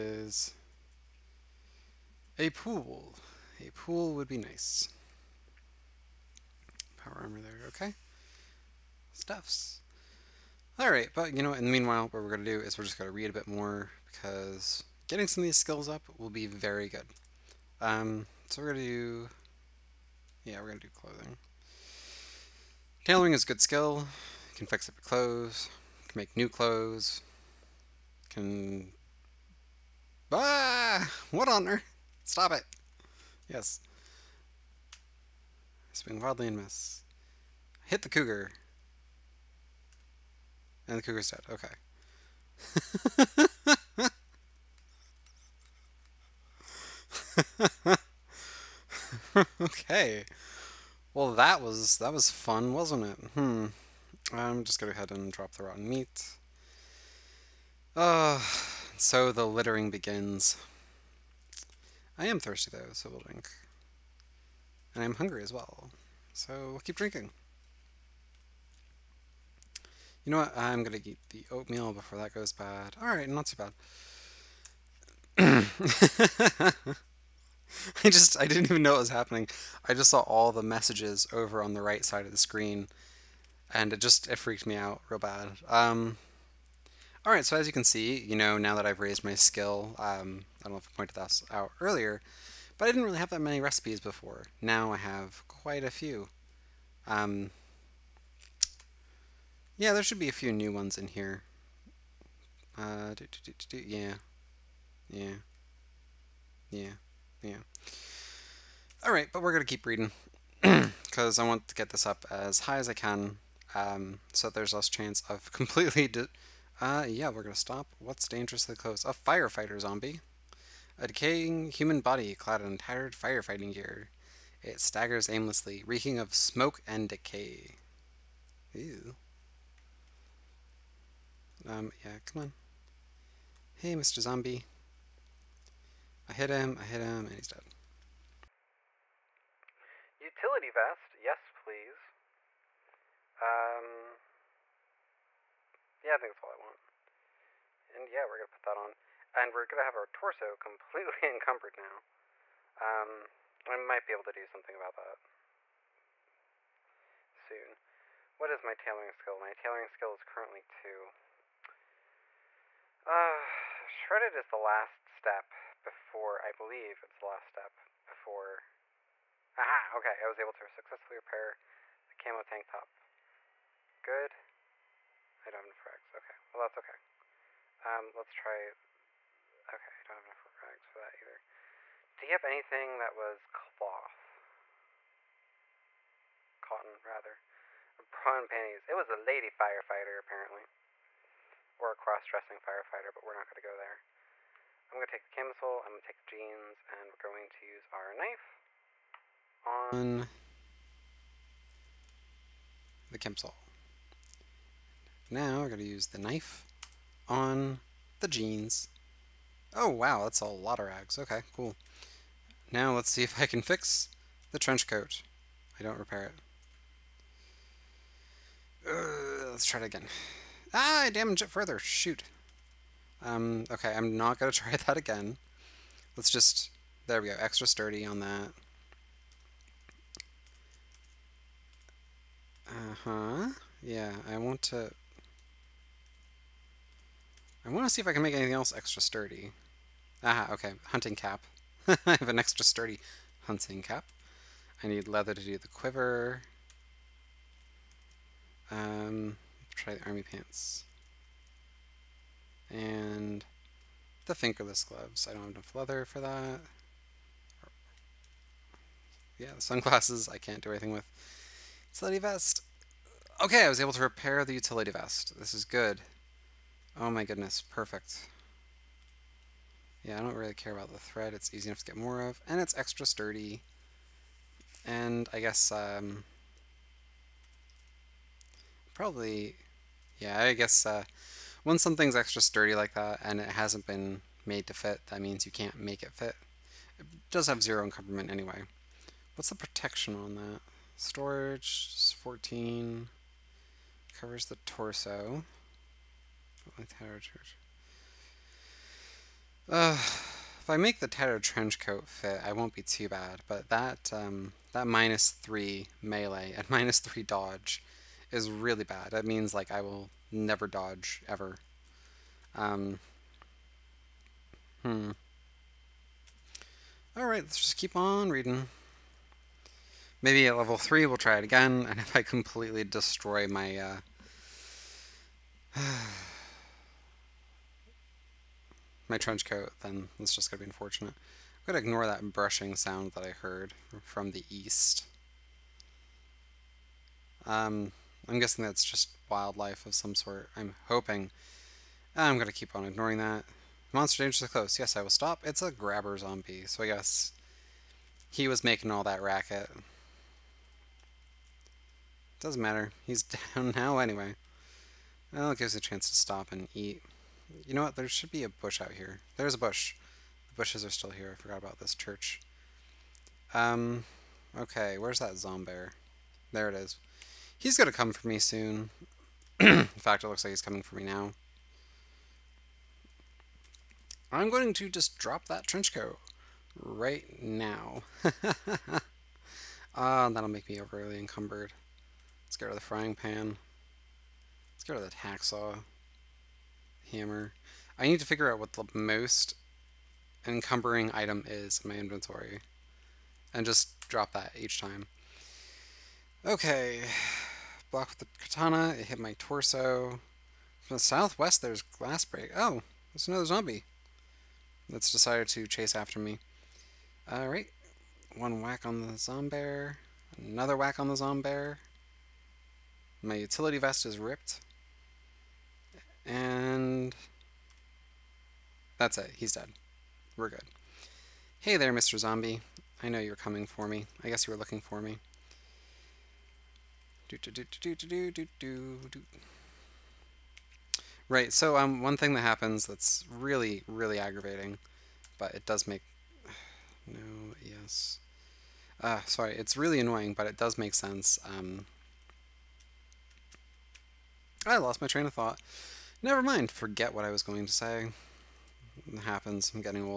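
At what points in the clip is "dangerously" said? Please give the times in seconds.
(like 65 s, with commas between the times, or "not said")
118 s, 344 s.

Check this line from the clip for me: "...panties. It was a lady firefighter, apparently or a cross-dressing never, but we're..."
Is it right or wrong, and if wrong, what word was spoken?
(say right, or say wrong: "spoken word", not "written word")
wrong: "firefighter", not "never".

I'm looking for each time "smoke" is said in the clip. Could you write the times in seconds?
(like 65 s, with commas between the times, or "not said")
126 s.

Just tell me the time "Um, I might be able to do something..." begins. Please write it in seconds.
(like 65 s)
152 s.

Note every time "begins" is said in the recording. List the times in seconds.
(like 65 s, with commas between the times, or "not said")
59 s.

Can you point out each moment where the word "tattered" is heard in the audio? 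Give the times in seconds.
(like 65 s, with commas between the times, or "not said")
122 s, 301 s.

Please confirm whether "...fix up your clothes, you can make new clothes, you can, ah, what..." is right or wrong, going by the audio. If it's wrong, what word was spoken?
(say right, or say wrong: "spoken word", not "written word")
right.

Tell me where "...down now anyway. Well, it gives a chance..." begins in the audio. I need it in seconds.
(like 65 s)
353 s.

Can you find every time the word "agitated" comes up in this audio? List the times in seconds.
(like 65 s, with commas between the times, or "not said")
not said.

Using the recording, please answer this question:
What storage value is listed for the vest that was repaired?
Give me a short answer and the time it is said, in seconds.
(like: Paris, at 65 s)
14, at 292 s.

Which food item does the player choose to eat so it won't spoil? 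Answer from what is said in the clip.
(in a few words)
oatmeal.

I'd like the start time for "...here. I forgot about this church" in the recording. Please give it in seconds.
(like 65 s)
361 s.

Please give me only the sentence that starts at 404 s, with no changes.
That's decided to chase after me.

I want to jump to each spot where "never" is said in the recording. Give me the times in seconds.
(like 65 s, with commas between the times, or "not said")
310 s, 446 s.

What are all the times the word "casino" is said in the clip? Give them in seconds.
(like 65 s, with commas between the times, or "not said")
not said.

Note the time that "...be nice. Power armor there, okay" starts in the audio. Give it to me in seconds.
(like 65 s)
4 s.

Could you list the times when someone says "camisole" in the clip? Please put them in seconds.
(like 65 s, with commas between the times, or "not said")
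195 s, 203 s.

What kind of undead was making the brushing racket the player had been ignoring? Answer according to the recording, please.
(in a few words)
grabber zombie.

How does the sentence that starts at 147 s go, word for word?
And yeah, we're going to put that on.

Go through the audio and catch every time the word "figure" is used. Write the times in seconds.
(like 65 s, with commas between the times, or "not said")
388 s.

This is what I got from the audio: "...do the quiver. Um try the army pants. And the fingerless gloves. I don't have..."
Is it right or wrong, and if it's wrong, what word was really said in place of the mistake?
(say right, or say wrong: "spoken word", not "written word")
right.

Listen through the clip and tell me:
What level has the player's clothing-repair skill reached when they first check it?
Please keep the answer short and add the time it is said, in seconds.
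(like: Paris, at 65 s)
2, at 160 s.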